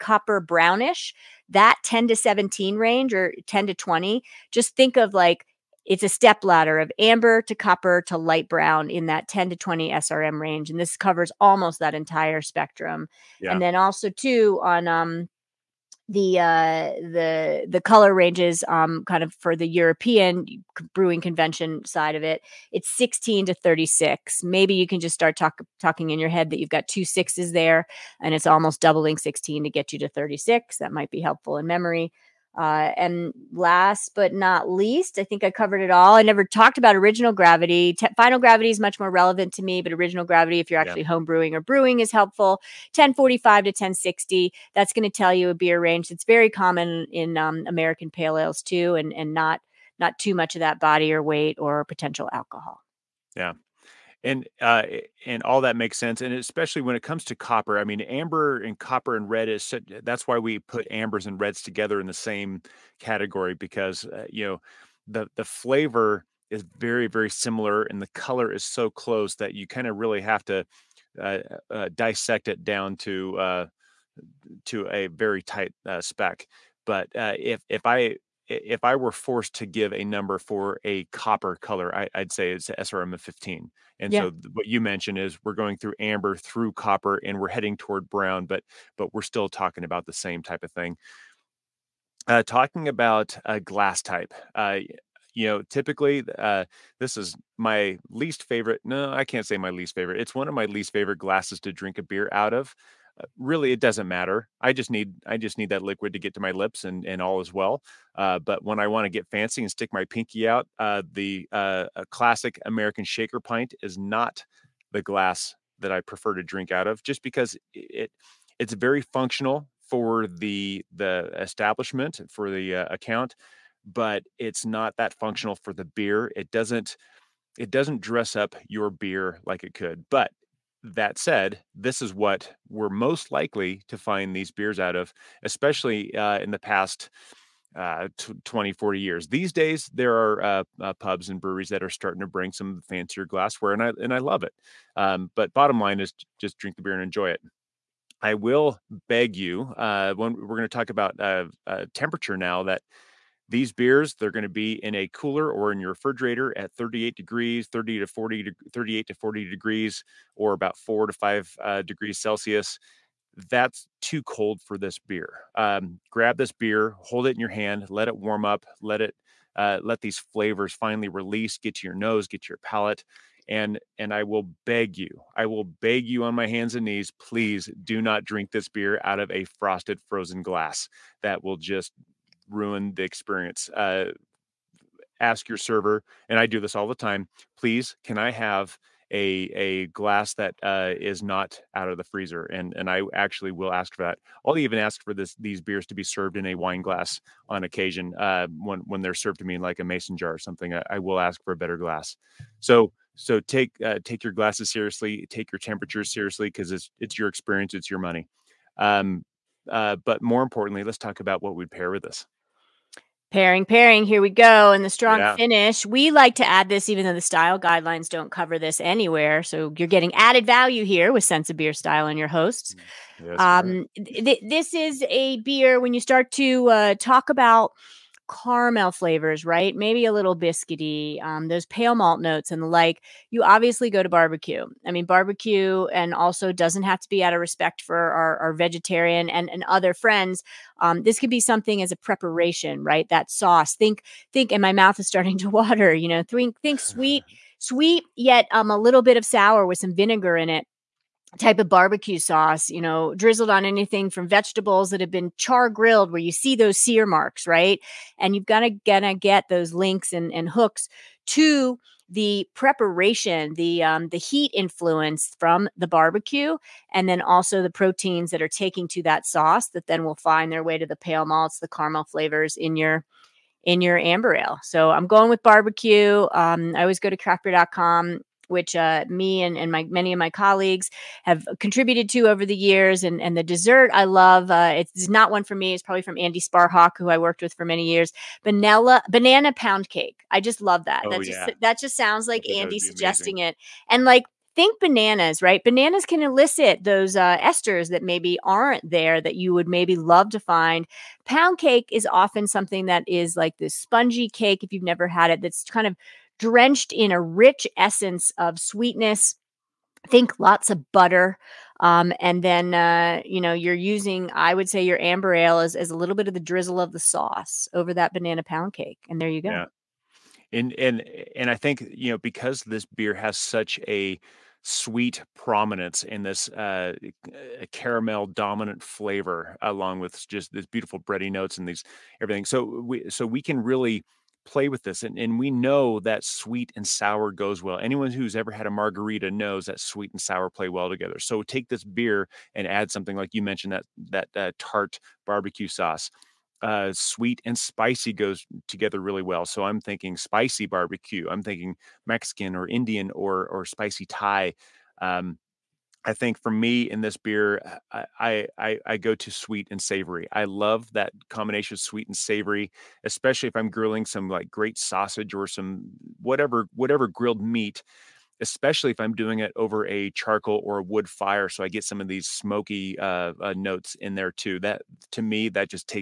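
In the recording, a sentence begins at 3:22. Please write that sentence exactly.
So so take uh, take your glasses seriously, take your temperatures seriously because it's it's your experience, it's your money.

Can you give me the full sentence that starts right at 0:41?
home brewing or brewing, is helpful.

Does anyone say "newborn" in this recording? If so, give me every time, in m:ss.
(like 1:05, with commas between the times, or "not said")
not said.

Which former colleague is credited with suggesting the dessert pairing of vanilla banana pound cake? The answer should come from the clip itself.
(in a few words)
Andy Sparhawk.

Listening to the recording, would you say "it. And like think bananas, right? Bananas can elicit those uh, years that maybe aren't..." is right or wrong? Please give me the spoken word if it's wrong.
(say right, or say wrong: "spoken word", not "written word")
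wrong: "esters", not "years".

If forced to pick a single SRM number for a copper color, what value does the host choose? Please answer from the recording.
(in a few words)
15.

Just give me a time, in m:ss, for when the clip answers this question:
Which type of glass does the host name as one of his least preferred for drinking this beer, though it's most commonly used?
1:52.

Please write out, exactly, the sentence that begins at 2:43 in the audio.
That's too cold for this beer.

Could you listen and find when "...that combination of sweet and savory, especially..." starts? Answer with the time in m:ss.
6:00.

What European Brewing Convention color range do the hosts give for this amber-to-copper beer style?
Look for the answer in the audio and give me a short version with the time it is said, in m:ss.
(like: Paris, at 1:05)
16 to 36, at 0:22.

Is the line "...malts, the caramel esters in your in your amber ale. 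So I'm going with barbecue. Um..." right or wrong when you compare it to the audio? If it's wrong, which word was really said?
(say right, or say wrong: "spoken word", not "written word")
wrong: "flavors", not "esters".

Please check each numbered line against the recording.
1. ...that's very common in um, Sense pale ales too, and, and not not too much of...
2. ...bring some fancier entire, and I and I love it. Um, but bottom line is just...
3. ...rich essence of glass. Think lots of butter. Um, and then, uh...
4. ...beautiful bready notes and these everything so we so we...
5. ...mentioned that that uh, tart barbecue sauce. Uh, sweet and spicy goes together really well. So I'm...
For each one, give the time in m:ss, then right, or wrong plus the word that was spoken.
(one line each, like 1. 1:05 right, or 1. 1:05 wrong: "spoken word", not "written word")
1. 0:46 wrong: "American", not "Sense"
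2. 2:22 wrong: "glassware", not "entire"
3. 5:07 wrong: "sweetness", not "glass"
4. 5:30 right
5. 5:43 right.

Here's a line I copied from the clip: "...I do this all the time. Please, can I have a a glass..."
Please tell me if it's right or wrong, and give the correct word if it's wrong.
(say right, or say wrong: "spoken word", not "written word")
right.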